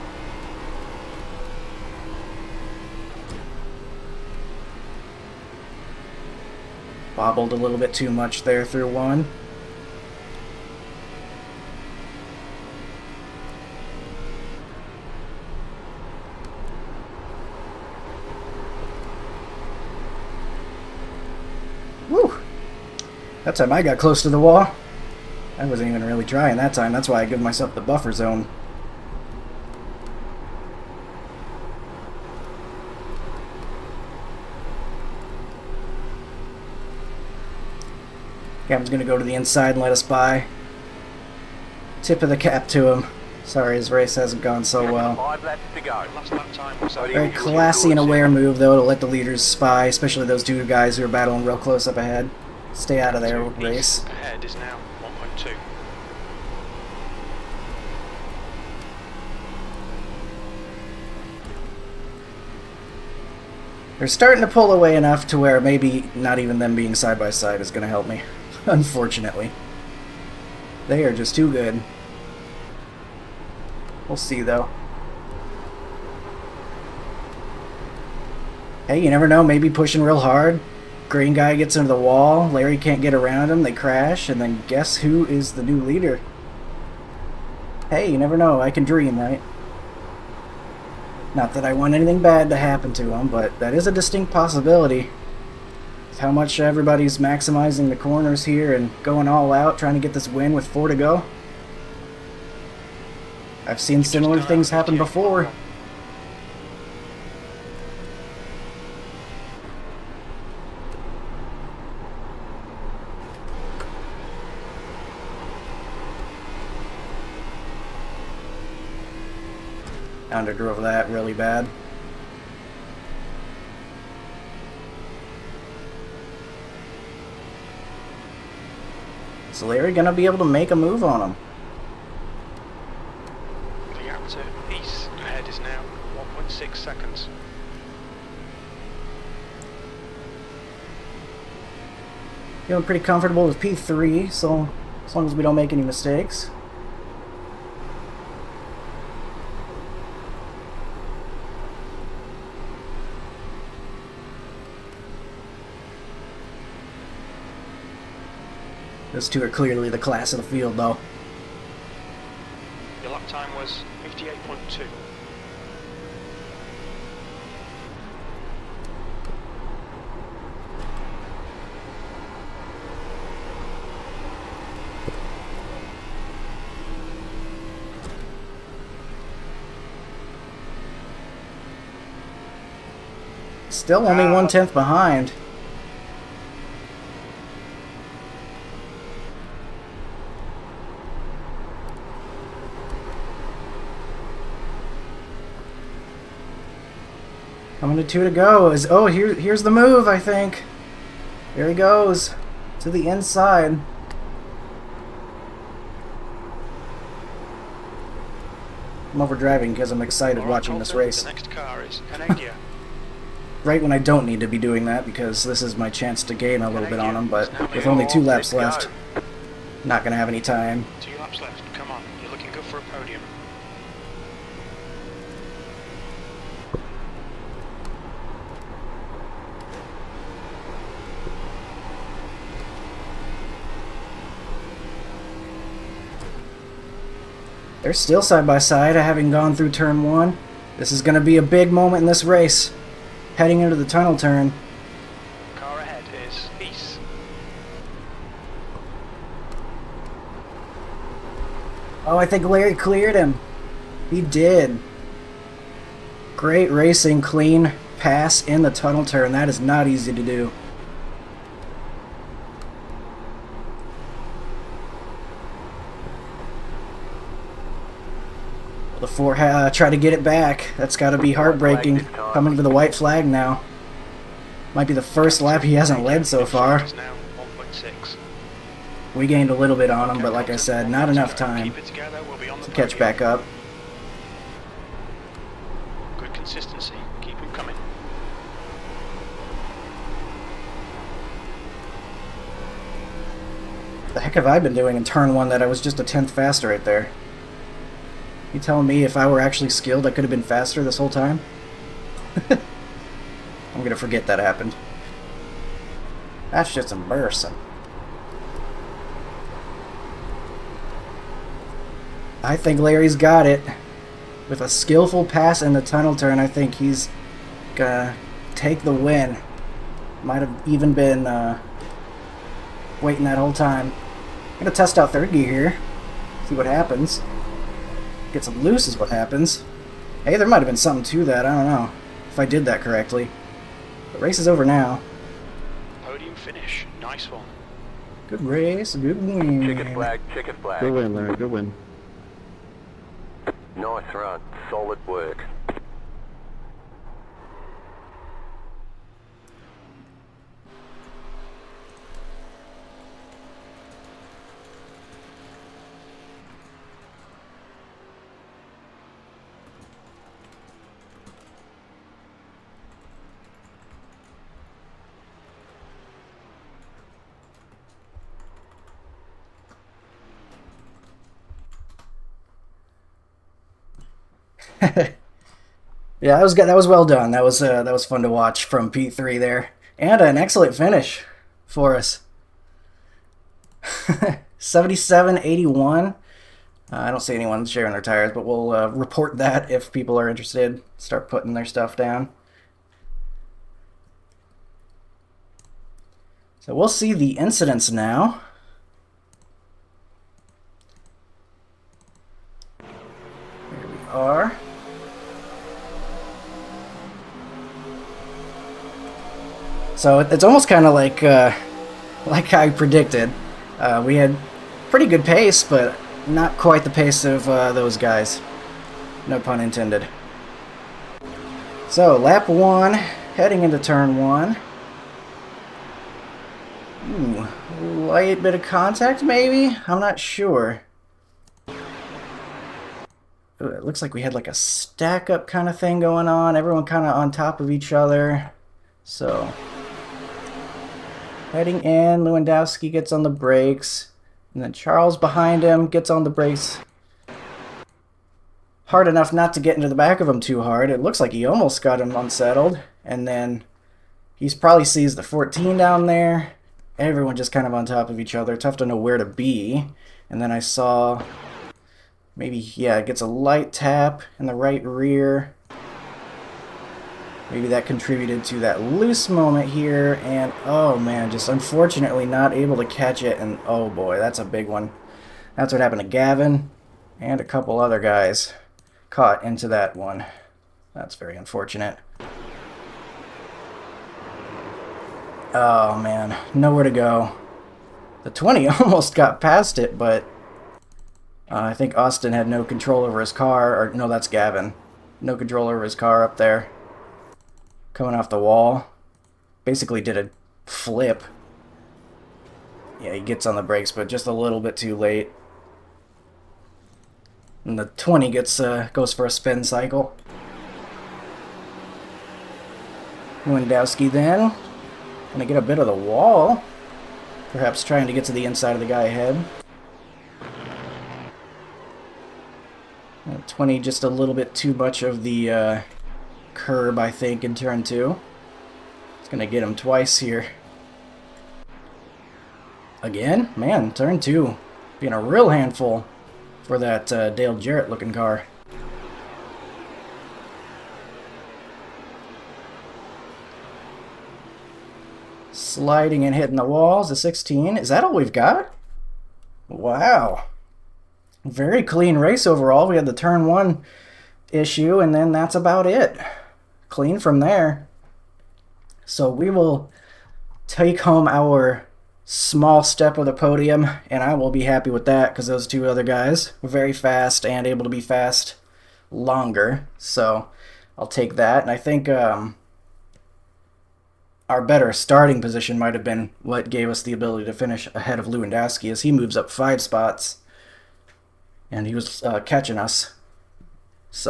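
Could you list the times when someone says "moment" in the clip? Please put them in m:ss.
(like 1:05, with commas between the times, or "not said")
4:01, 7:49.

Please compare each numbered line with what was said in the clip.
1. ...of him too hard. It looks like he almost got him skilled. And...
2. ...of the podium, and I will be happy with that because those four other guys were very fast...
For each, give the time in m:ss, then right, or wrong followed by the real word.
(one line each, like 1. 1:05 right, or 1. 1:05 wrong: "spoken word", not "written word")
1. 7:30 wrong: "unsettled", not "skilled"
2. 9:23 wrong: "two", not "four".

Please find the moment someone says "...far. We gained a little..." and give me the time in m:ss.
4:36.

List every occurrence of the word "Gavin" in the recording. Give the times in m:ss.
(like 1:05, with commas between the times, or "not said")
7:56, 8:14.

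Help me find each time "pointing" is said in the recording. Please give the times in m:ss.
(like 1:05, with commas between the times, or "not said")
not said.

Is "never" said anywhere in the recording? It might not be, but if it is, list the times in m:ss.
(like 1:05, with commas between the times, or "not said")
1:19, 1:28.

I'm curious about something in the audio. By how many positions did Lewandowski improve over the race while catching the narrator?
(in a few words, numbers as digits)
5.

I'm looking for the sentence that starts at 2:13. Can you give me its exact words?
The outer east ahead is now 1.6 seconds.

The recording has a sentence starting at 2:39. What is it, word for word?
Those two are clearly the class of the field, though.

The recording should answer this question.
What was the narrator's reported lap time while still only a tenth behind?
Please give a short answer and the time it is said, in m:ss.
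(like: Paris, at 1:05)
58.2, at 2:44.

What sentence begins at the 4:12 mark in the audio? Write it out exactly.
Oh, I think Larry cleared him.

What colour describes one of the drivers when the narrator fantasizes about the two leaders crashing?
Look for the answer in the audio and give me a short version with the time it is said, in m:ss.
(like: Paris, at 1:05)
Green, at 1:21.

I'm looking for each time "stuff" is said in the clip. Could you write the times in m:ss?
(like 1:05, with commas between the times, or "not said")
6:31.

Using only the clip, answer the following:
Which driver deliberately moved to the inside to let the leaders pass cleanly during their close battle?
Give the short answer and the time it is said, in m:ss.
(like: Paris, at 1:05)
Captain, at 0:38.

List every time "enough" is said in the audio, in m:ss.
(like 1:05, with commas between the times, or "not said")
1:04, 4:41, 7:29.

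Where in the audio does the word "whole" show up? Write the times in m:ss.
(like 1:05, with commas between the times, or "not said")
5:00, 5:23.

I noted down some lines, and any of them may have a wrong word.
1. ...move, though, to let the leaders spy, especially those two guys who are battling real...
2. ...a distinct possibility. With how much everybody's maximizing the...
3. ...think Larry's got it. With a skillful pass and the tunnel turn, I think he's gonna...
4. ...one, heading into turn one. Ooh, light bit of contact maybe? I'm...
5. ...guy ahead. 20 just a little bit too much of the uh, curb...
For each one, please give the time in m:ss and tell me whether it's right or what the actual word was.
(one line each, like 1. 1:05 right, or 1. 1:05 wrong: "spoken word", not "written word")
1. 0:48 right
2. 1:33 right
3. 5:12 right
4. 7:02 right
5. 8:38 right.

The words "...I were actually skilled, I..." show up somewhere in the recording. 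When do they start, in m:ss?
4:59.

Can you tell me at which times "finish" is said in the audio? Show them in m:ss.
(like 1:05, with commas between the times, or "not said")
5:36, 6:20, 9:37.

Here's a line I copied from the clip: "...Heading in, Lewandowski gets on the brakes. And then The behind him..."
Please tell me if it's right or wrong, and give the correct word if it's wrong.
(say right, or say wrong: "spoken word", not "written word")
wrong: "Charles", not "The".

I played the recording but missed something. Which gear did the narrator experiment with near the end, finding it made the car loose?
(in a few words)
third gear.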